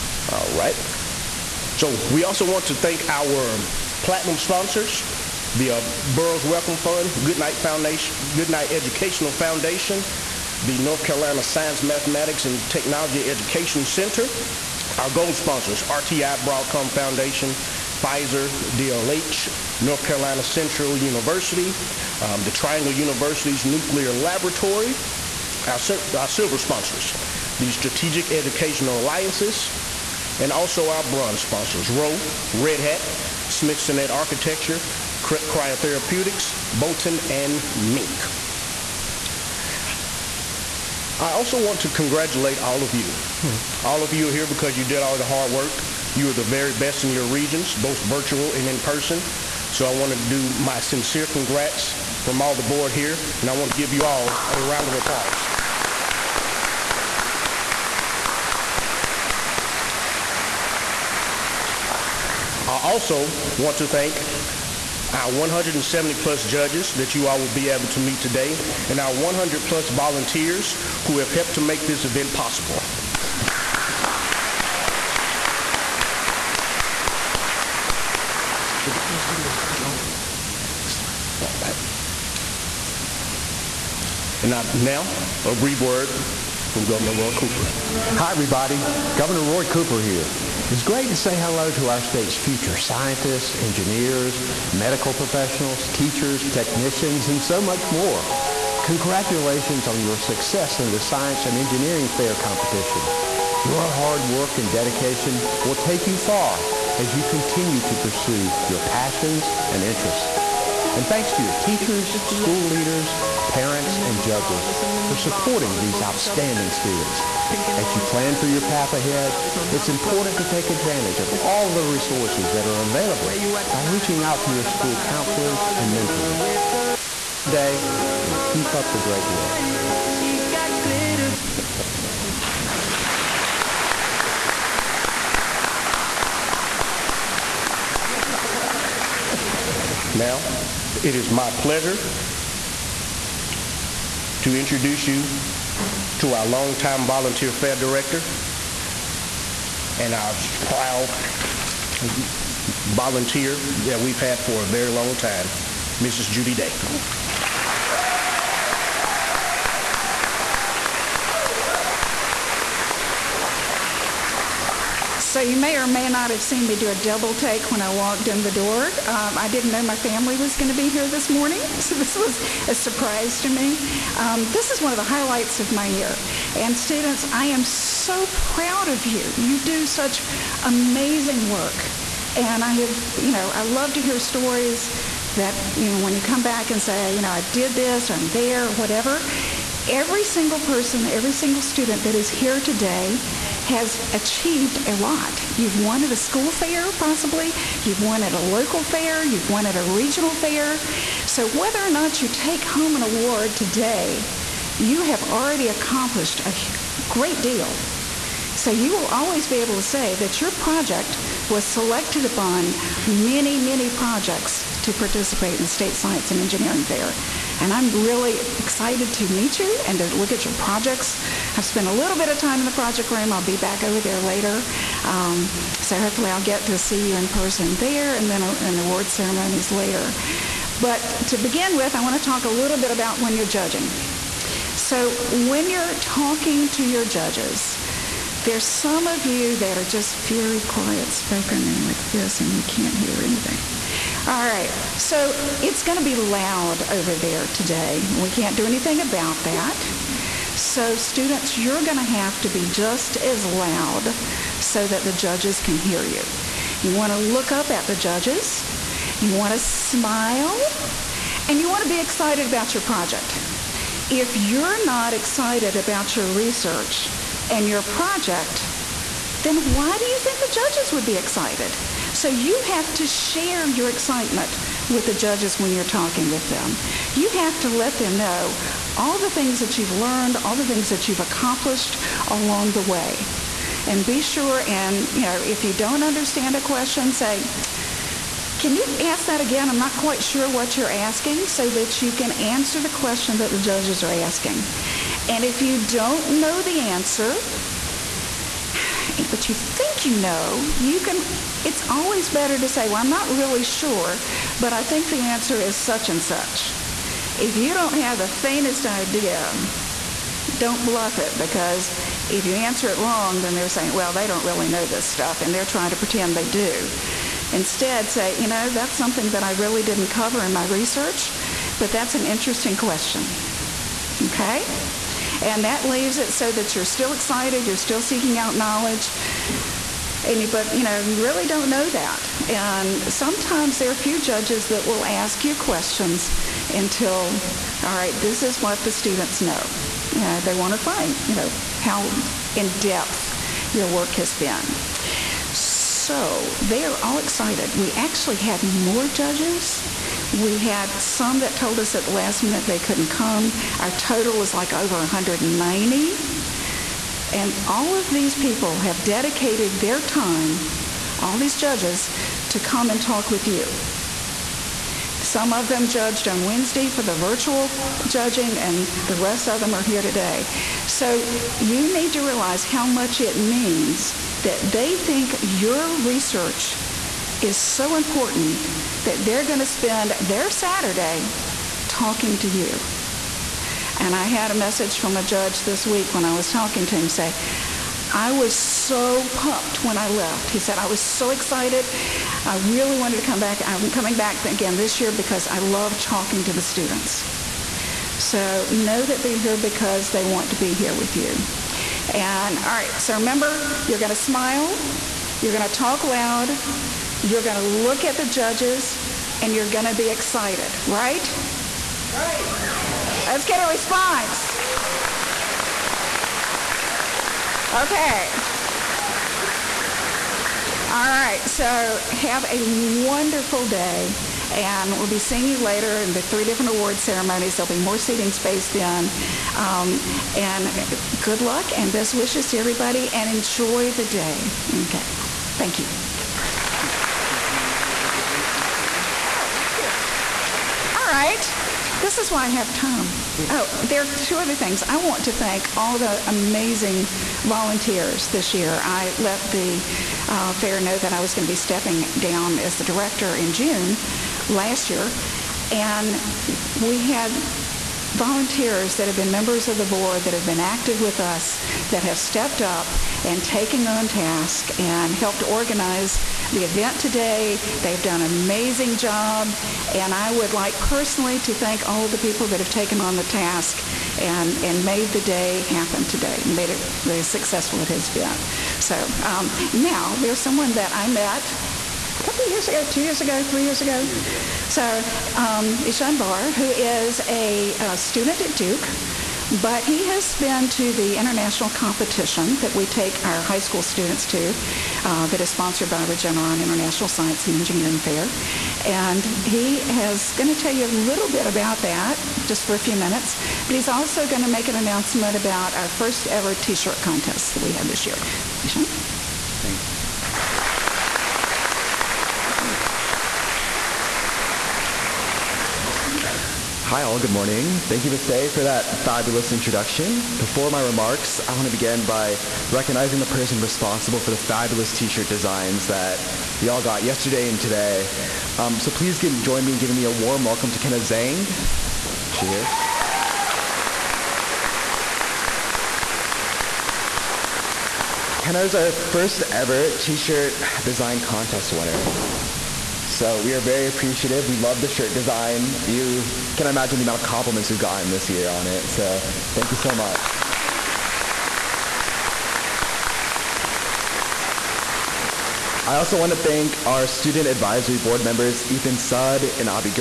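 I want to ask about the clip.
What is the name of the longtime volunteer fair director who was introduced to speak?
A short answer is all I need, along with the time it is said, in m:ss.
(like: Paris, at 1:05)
Judy Day, at 2:36.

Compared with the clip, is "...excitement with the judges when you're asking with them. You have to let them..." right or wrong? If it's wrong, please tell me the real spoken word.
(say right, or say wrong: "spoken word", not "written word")
wrong: "talking", not "asking".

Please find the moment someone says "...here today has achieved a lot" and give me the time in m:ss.
3:12.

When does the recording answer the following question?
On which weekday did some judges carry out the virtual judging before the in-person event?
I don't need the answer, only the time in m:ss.
6:06.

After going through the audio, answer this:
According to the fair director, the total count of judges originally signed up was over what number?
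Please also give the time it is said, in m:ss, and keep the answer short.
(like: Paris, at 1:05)
190, at 5:54.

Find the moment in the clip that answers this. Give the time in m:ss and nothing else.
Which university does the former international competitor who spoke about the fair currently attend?
8:08.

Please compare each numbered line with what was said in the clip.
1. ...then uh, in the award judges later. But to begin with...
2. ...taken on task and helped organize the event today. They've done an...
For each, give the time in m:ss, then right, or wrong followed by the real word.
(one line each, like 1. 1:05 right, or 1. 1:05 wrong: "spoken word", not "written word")
1. 3:48 wrong: "ceremonies", not "judges"
2. 7:43 right.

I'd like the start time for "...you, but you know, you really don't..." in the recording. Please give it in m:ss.
5:30.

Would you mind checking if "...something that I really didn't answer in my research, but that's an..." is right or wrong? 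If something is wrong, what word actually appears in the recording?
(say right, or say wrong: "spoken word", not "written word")
wrong: "cover", not "answer".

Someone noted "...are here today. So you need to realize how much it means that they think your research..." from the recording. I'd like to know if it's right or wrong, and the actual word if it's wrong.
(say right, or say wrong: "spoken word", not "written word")
right.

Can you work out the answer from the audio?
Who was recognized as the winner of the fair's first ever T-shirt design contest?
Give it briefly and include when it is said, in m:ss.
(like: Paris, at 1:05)
Kenna Zhang, at 8:50.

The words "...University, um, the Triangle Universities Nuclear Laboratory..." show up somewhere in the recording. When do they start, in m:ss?
0:20.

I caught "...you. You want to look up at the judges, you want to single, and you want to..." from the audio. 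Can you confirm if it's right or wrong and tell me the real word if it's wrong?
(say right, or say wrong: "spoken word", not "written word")
wrong: "smile", not "single".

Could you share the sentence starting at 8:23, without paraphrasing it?
But he's also going to make an announcement about our first ever T-shirt contest that we had this year.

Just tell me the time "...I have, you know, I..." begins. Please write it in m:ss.
3:02.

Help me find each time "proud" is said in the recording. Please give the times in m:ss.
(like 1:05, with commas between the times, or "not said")
2:30, 2:58.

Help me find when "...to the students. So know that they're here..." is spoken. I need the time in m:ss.
6:36.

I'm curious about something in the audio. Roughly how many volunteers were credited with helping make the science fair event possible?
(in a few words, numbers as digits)
100 plus.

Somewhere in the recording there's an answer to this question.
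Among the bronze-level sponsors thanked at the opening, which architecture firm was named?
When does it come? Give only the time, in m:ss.
0:33.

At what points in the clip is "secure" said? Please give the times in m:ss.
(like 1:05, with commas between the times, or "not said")
not said.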